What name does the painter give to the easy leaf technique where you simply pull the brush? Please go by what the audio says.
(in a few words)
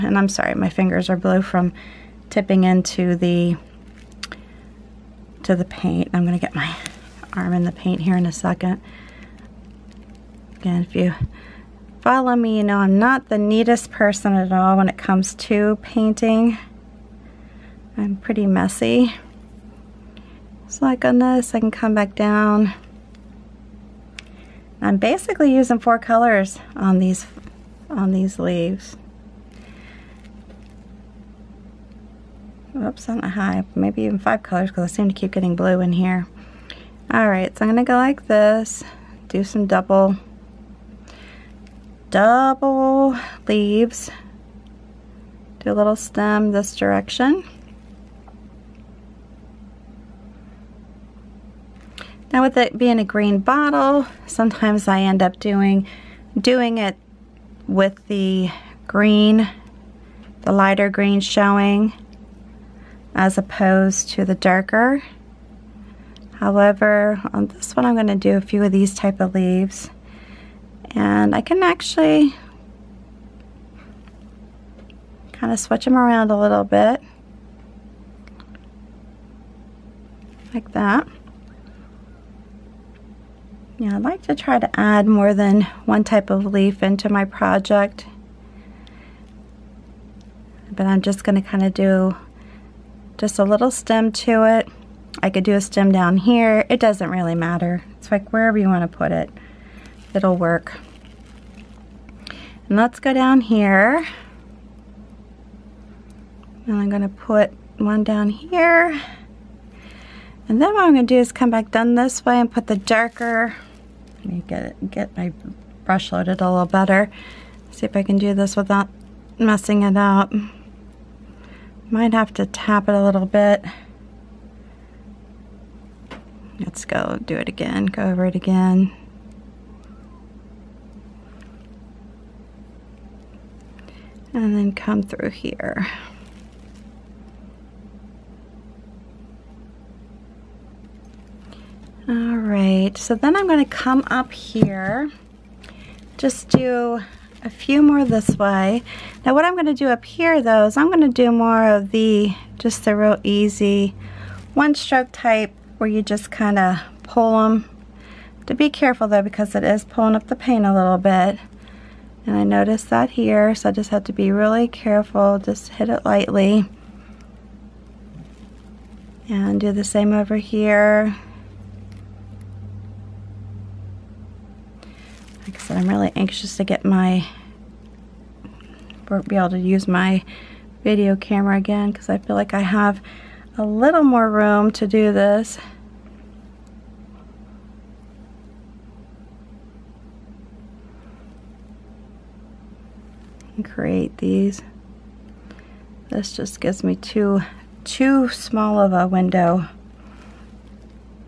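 One stroke.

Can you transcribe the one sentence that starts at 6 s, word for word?
I'm gonna get my arm in the paint here in a second.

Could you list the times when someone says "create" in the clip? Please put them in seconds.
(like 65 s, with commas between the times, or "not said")
193 s.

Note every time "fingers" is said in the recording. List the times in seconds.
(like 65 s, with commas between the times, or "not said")
0 s.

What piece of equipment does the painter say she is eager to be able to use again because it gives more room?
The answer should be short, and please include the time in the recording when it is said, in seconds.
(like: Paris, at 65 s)
Video camera, at 180 s.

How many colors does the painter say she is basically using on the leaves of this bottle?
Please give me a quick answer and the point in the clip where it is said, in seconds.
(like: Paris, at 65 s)
4, at 25 s.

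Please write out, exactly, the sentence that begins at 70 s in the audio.
And I can actually kind of switch them around a little bit.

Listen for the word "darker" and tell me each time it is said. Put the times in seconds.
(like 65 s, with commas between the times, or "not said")
64 s, 112 s.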